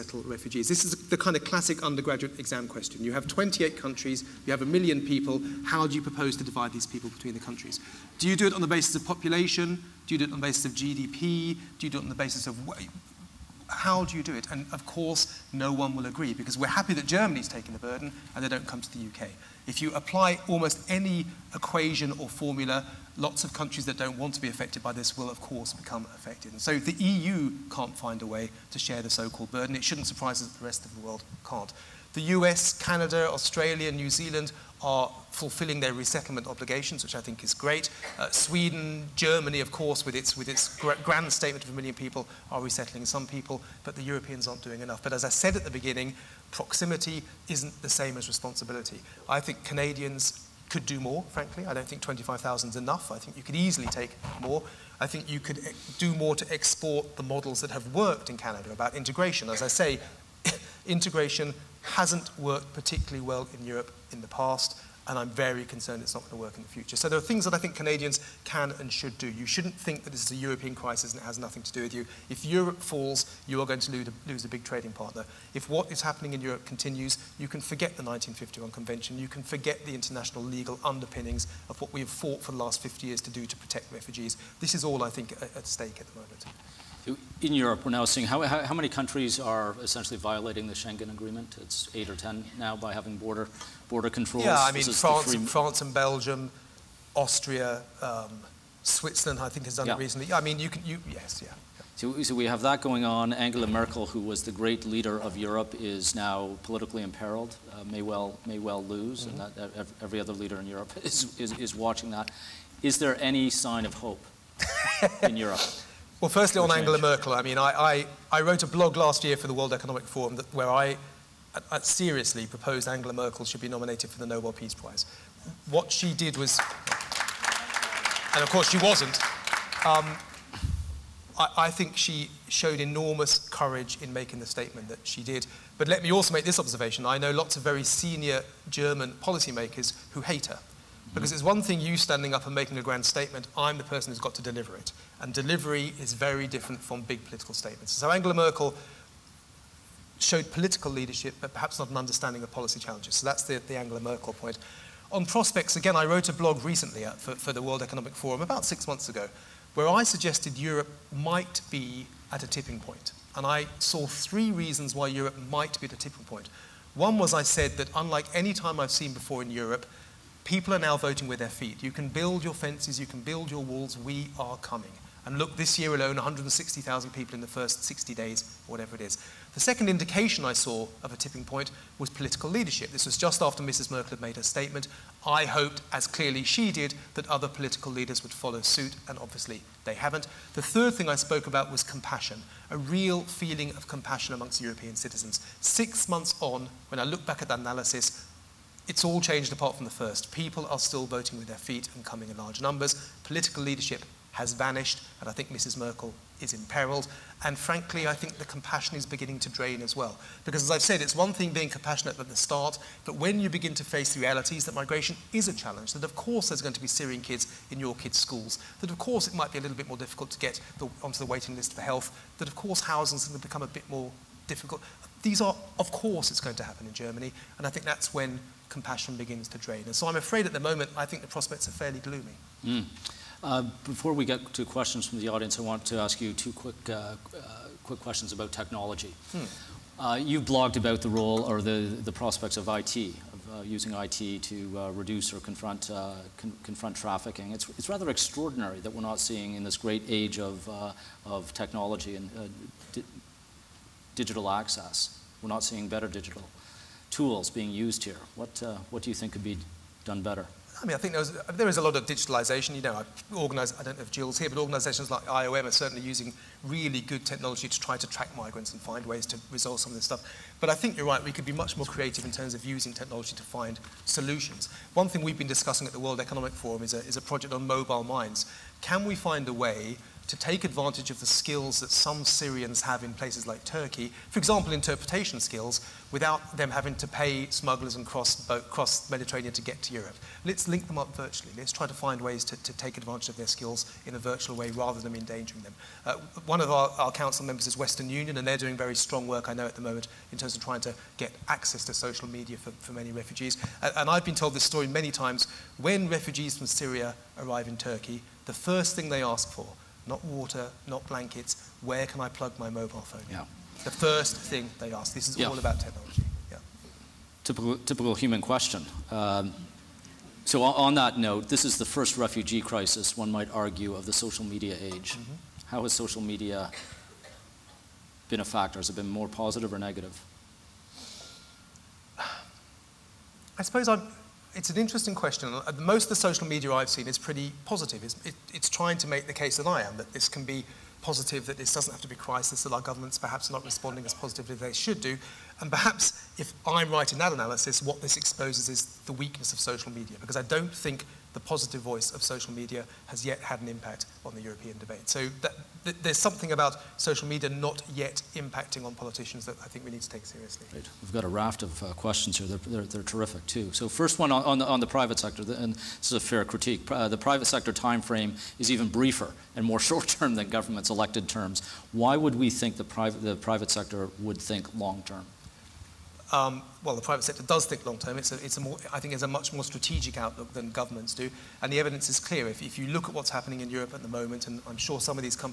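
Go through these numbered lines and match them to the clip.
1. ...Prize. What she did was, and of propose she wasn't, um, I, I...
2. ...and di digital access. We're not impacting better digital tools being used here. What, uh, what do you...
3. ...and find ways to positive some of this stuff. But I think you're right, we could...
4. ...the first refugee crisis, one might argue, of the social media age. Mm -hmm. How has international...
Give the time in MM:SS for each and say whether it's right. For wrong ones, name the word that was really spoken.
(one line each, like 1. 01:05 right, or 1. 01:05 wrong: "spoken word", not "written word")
1. 02:04 wrong: "course", not "propose"
2. 04:12 wrong: "seeing", not "impacting"
3. 04:28 wrong: "resolve", not "positive"
4. 05:21 wrong: "social", not "international".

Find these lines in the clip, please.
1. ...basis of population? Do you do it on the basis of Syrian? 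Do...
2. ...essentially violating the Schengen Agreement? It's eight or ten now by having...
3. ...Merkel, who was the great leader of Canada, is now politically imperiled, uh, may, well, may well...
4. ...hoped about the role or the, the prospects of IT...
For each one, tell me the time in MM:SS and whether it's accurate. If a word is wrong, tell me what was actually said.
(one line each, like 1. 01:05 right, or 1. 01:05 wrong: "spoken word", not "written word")
1. 00:08 wrong: "GDP", not "Syrian"
2. 01:29 right
3. 01:43 wrong: "Europe", not "Canada"
4. 04:00 wrong: "blogged", not "hoped".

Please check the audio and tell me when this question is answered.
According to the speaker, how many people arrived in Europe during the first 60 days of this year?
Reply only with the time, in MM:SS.
02:56.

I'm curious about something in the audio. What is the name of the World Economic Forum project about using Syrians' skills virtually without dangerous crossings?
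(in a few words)
Mobile minds.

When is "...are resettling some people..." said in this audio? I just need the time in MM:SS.
00:42.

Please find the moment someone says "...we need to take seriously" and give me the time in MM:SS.
05:59.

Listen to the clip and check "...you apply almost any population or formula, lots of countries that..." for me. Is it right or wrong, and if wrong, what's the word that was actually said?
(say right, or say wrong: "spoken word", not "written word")
wrong: "equation", not "population".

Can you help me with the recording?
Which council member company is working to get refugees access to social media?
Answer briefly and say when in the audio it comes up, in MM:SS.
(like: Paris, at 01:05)
Western Union, at 04:57.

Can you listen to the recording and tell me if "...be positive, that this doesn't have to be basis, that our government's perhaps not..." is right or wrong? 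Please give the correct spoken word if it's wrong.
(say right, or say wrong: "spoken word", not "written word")
wrong: "crisis", not "basis".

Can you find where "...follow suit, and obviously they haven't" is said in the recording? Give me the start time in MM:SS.
03:08.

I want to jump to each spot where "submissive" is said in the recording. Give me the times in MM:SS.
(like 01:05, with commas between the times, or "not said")
not said.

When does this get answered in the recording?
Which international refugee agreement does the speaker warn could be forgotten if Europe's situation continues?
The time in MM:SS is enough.
01:18.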